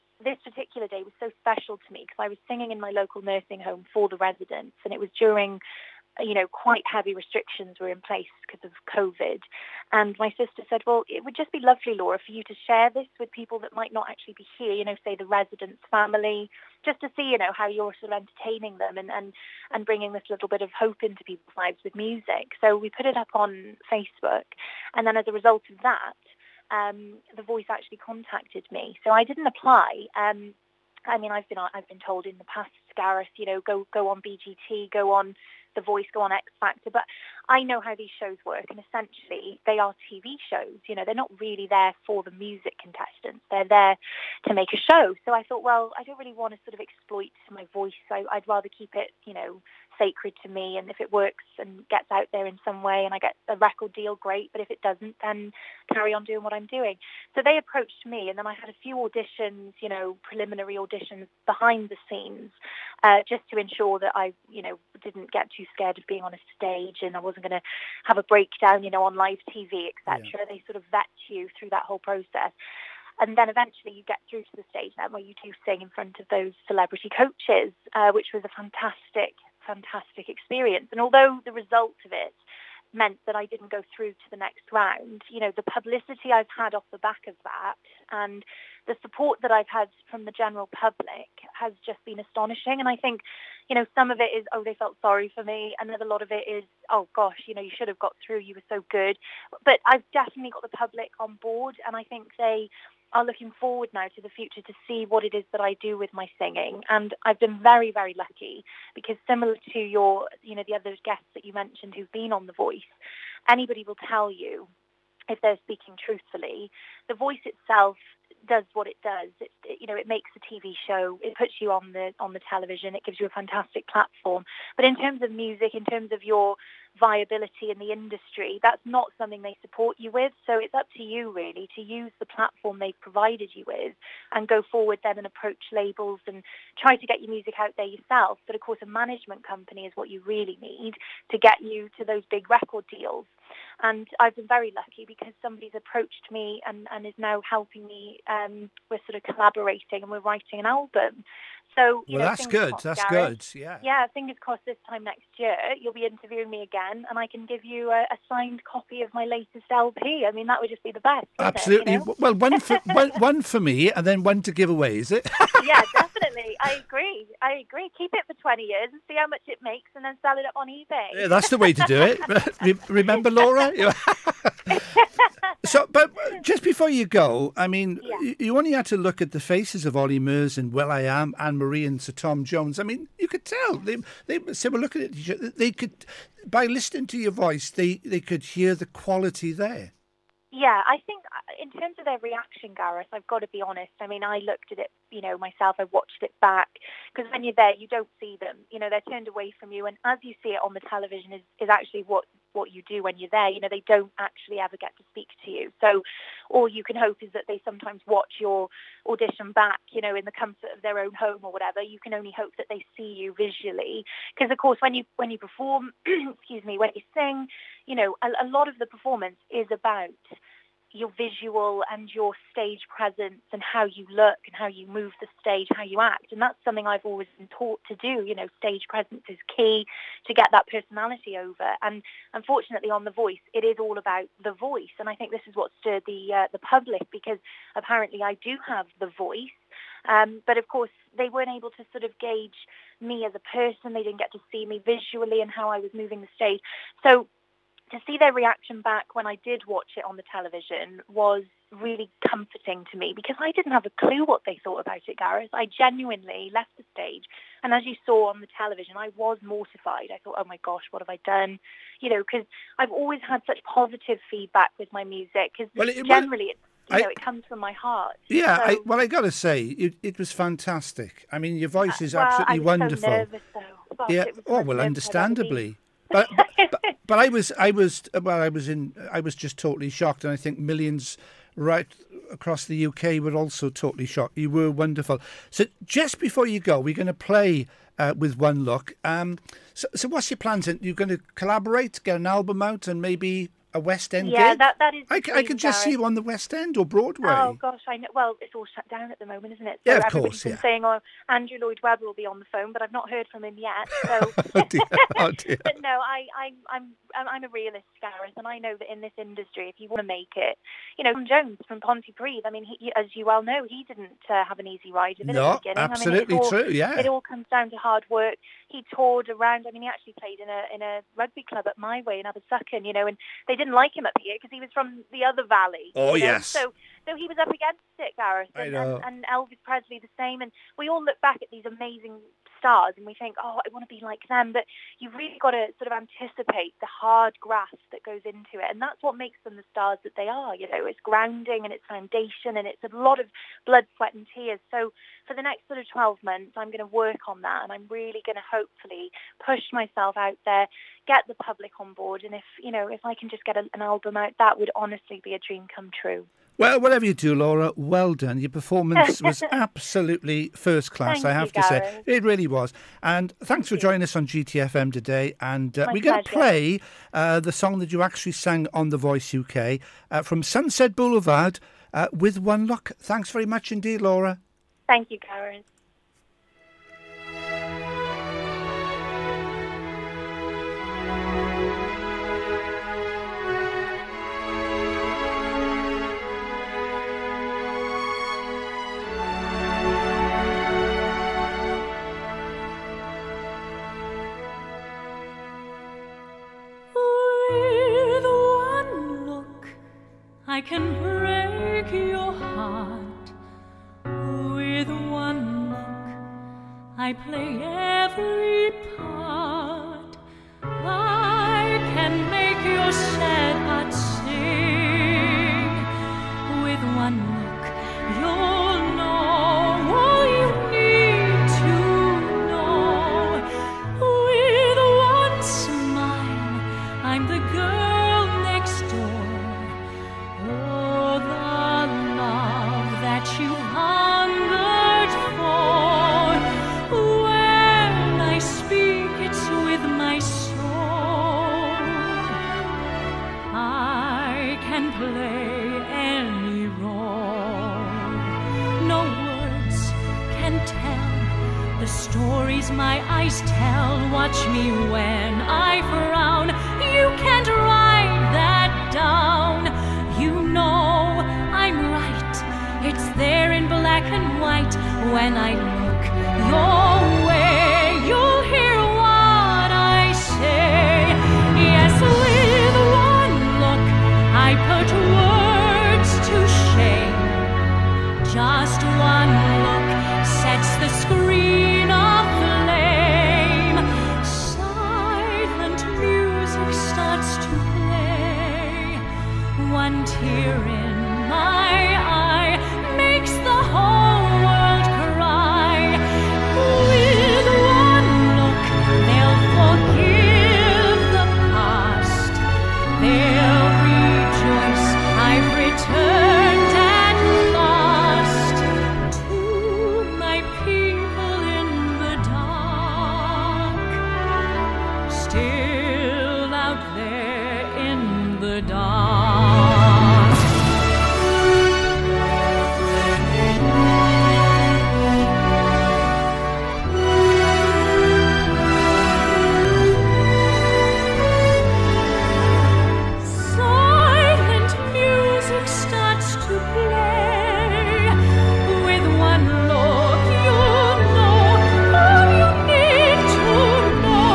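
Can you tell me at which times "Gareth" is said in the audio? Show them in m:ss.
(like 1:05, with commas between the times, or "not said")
0:32, 3:12, 4:15, 5:08, 5:28.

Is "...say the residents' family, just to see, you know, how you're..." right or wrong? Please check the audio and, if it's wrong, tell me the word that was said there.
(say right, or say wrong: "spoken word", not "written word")
right.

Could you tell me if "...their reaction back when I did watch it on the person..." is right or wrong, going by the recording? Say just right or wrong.
wrong.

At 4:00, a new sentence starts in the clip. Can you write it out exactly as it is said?
Um, but of course, they weren't able to sort of gauge me as a person.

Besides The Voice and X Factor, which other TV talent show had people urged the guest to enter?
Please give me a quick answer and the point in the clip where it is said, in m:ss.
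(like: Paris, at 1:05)
BGT, at 0:34.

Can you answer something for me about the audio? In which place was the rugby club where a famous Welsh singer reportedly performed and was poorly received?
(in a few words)
Abersychan.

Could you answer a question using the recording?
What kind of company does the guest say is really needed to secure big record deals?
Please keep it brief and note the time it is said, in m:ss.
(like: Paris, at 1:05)
a management company, at 2:18.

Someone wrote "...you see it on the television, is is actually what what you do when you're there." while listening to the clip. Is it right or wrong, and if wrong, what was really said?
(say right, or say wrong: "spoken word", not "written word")
right.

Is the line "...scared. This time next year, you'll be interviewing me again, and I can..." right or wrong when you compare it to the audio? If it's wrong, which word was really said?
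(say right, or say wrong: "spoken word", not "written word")
wrong: "crossed", not "scared".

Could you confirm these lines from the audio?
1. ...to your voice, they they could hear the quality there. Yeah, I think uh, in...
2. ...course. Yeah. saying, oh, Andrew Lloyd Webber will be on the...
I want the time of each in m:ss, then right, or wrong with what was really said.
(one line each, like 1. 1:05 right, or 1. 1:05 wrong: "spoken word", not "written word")
1. 3:07 right
2. 5:00 right.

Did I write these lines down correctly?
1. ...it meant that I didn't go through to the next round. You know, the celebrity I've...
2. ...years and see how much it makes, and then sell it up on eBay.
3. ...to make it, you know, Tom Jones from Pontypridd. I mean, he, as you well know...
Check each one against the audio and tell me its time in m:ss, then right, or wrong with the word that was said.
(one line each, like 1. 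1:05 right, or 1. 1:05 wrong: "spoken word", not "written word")
1. 1:22 wrong: "publicity", not "celebrity"
2. 2:48 right
3. 5:10 right.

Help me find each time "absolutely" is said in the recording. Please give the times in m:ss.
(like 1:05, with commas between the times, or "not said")
2:41, 4:32, 5:15, 5:59.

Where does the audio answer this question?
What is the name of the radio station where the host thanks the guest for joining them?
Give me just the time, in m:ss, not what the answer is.
6:04.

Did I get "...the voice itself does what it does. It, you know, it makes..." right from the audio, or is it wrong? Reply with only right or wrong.
right.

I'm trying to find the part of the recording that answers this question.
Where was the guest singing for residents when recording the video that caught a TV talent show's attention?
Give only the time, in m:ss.
0:02.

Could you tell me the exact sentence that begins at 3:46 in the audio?
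And that's something I've always been taught to do.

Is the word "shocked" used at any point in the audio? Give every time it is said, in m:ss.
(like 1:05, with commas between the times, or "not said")
4:39, 4:44.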